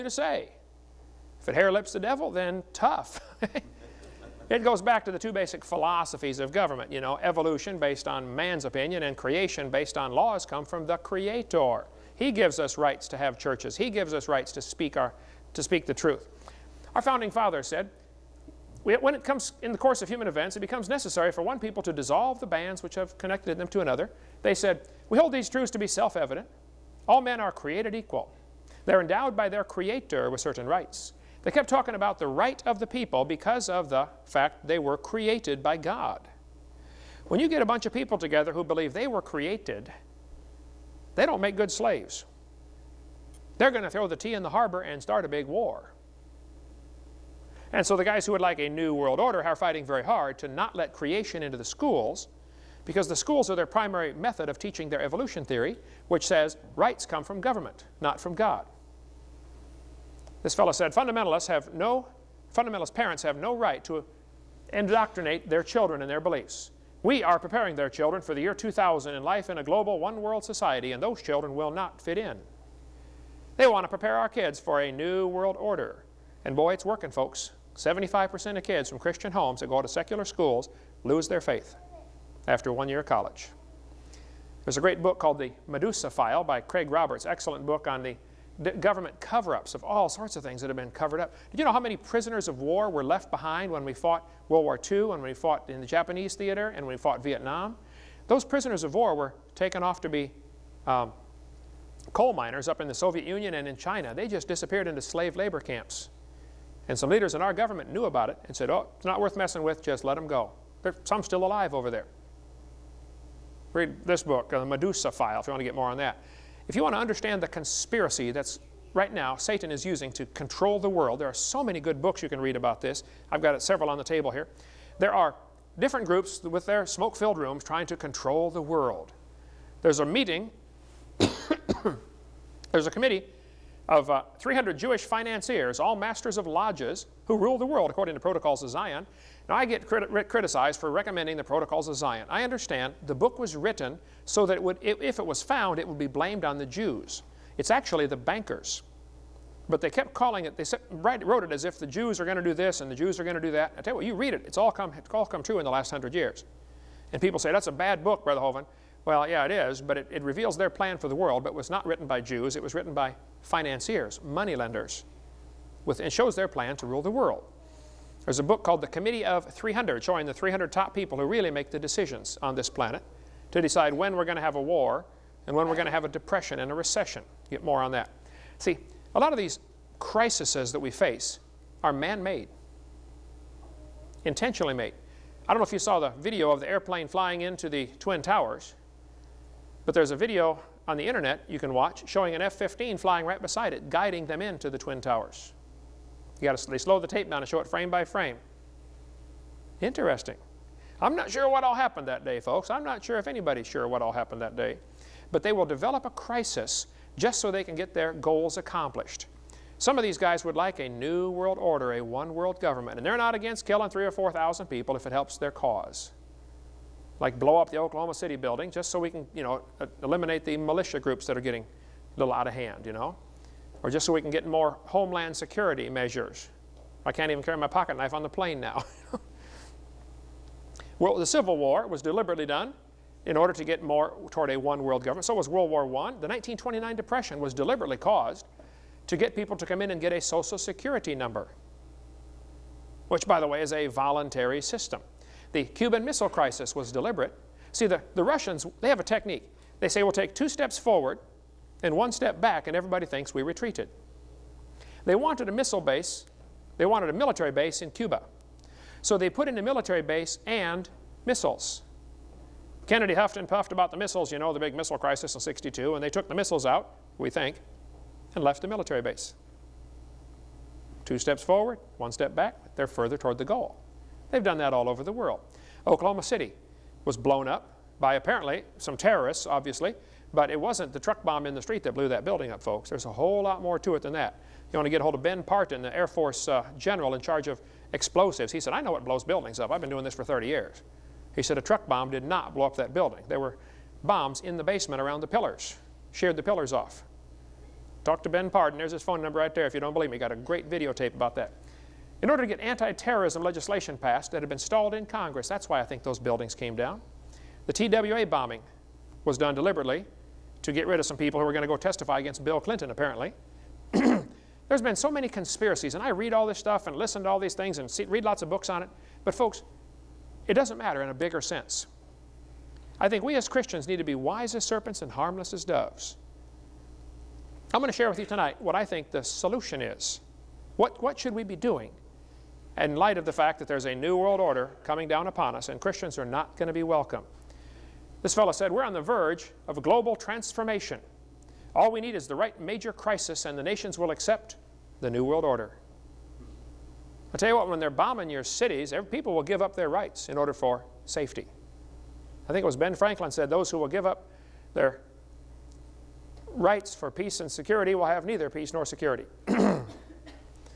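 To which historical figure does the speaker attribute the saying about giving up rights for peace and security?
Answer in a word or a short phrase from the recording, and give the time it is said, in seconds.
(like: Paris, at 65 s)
Ben Franklin, at 352 s.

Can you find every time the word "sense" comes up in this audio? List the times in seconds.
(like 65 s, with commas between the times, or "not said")
321 s.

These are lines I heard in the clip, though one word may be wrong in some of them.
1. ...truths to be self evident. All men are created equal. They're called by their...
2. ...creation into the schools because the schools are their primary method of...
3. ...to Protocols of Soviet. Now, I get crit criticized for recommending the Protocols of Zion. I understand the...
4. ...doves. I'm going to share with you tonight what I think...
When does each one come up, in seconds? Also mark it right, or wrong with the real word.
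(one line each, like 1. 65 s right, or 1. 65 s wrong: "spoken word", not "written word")
1. 25 s wrong: "endowed", not "called"
2. 50 s right
3. 138 s wrong: "Zion", not "Soviet"
4. 325 s right.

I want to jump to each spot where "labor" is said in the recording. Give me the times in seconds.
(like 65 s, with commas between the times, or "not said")
105 s.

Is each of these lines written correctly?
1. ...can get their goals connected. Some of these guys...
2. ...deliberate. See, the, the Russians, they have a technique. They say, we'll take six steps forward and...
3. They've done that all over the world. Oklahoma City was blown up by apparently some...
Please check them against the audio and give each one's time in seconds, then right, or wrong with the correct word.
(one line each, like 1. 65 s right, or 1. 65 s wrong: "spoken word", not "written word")
1. 207 s wrong: "accomplished", not "connected"
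2. 246 s wrong: "two", not "six"
3. 274 s right.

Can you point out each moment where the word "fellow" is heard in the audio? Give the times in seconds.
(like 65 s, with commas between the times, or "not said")
60 s, 338 s.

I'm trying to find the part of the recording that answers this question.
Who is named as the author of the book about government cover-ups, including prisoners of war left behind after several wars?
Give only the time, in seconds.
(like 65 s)
86 s.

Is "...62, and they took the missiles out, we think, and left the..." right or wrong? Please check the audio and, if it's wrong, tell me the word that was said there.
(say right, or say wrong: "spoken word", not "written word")
right.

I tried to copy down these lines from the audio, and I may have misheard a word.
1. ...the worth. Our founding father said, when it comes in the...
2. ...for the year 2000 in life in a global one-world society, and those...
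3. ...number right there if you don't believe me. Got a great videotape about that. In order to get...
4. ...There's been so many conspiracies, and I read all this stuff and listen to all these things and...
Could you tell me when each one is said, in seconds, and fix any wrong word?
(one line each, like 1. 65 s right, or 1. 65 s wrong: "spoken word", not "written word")
1. 15 s wrong: "truth", not "worth"
2. 68 s right
3. 299 s right
4. 314 s right.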